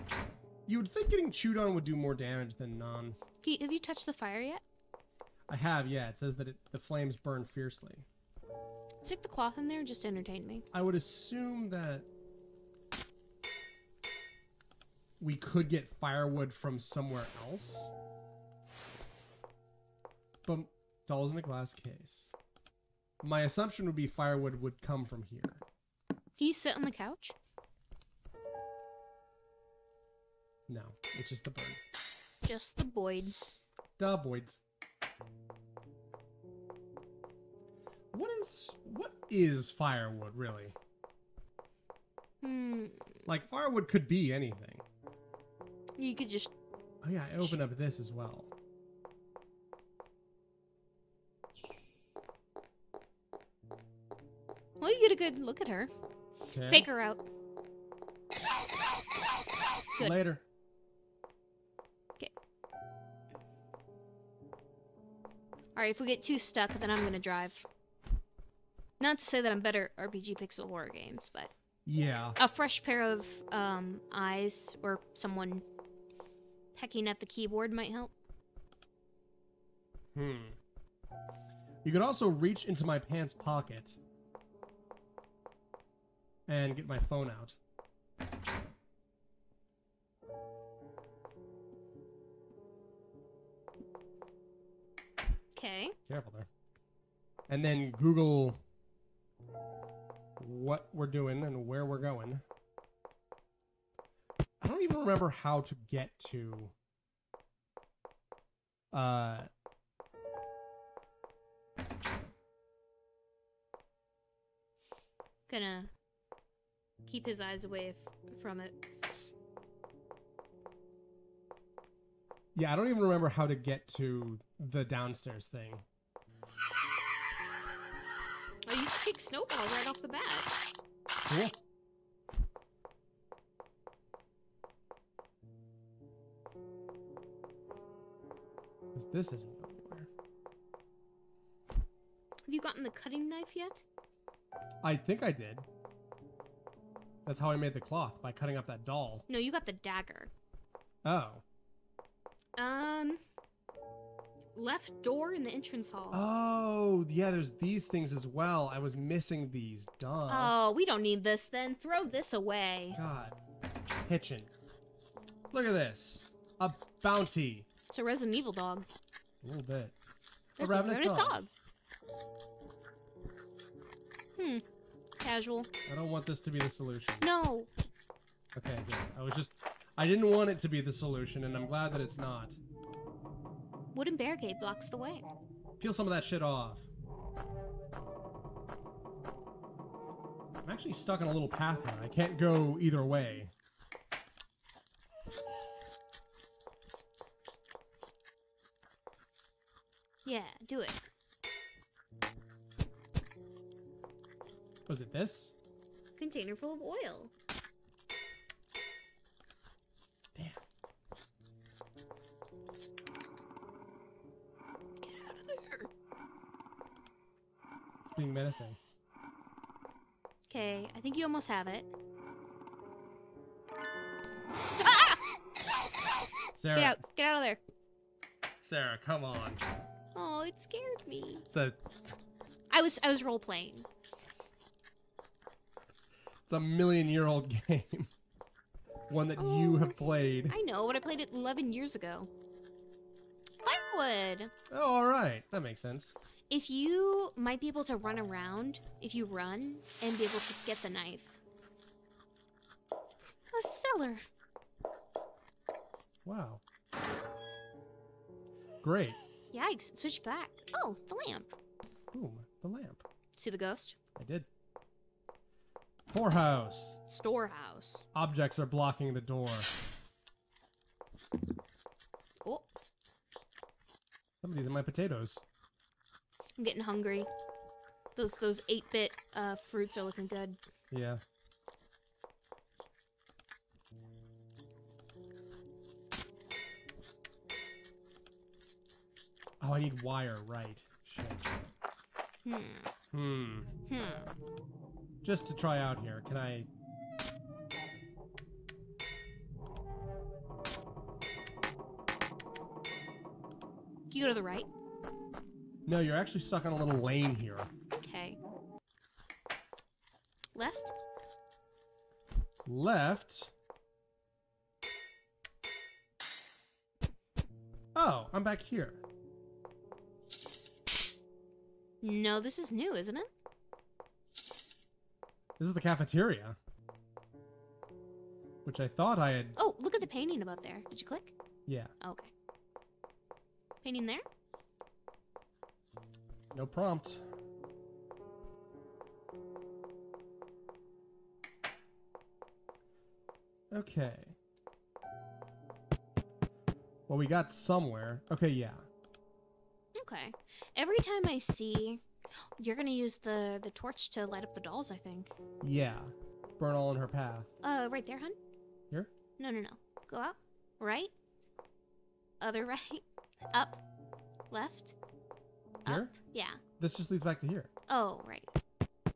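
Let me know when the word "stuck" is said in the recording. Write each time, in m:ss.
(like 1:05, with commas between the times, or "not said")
1:06, 3:10, 5:06.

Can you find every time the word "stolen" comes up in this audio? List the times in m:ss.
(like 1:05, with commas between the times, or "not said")
not said.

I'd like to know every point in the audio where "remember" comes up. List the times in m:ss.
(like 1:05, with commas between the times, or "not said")
1:44, 2:03.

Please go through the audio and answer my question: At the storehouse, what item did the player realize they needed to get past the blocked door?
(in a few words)
wire.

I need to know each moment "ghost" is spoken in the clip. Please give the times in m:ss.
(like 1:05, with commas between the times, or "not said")
4:23.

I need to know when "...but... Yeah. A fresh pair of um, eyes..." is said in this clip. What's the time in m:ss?
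1:11.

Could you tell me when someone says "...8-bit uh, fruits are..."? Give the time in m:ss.
4:38.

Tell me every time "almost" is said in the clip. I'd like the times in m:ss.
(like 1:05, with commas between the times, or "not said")
3:41.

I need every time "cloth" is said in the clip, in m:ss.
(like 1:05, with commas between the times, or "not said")
0:09, 2:27.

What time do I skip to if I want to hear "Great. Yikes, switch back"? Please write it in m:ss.
4:18.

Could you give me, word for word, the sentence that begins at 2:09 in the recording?
like Snowball right off the bat.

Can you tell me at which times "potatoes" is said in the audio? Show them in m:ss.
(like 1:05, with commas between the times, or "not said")
4:34.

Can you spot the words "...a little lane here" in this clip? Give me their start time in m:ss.
5:06.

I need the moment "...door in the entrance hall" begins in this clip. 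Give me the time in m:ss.
2:35.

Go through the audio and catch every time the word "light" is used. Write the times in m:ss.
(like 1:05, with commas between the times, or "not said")
5:54.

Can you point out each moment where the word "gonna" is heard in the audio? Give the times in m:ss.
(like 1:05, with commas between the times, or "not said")
1:07, 1:55, 5:52.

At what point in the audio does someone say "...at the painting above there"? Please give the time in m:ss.
5:29.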